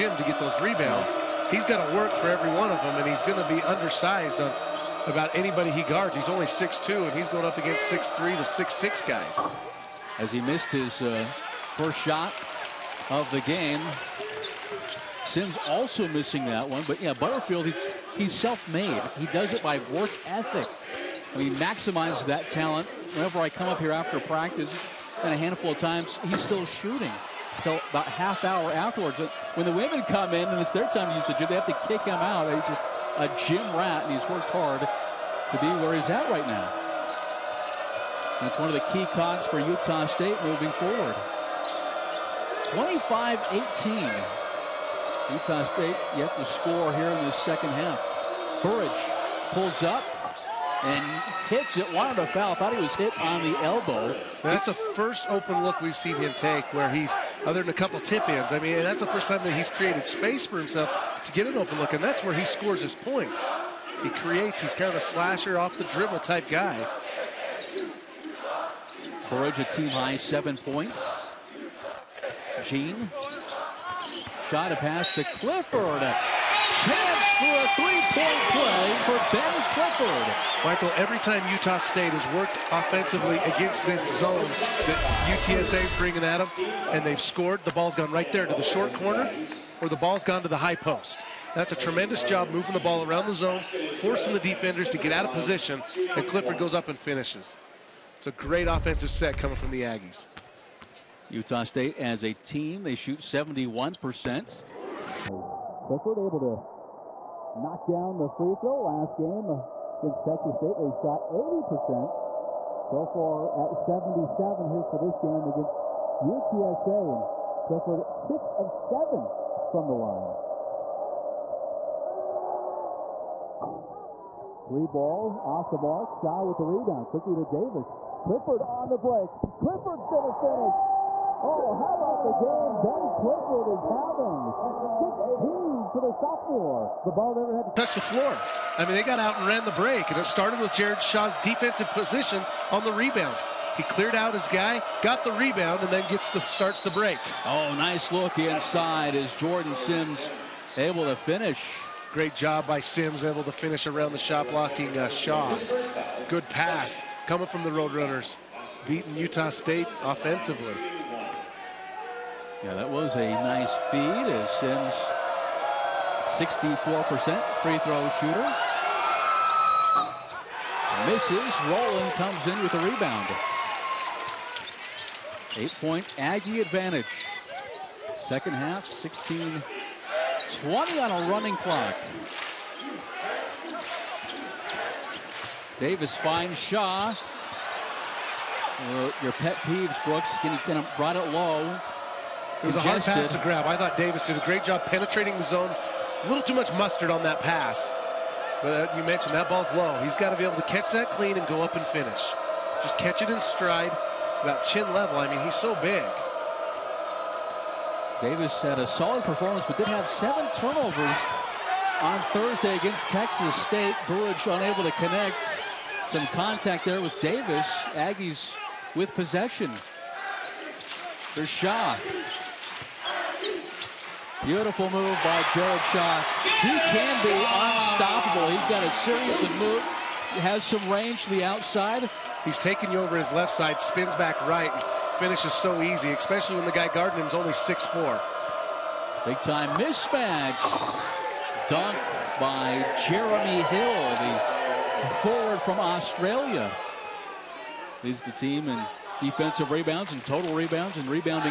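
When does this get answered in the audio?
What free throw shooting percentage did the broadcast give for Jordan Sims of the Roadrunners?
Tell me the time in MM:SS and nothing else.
02:46.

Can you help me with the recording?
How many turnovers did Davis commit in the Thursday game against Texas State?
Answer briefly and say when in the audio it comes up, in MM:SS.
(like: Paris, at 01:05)
7, at 03:30.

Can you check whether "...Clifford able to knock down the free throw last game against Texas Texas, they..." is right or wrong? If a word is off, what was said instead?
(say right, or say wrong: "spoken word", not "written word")
wrong: "State", not "Texas".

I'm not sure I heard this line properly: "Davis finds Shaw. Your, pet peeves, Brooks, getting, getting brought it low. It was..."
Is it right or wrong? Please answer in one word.
right.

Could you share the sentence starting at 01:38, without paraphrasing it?
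It's a great offensive set coming from the Aggies.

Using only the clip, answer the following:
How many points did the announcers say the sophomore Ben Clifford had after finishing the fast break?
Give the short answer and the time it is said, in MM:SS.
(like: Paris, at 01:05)
16, at 02:15.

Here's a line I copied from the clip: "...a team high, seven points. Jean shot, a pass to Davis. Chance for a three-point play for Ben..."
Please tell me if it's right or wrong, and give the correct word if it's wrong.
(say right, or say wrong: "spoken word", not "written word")
wrong: "Clifford", not "Davis".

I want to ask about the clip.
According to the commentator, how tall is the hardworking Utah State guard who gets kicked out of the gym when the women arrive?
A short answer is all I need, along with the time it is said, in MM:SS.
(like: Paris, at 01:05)
6'2", at 00:06.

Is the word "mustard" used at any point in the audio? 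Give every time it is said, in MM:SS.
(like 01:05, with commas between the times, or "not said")
03:16.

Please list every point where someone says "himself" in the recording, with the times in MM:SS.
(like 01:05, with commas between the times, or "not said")
01:00.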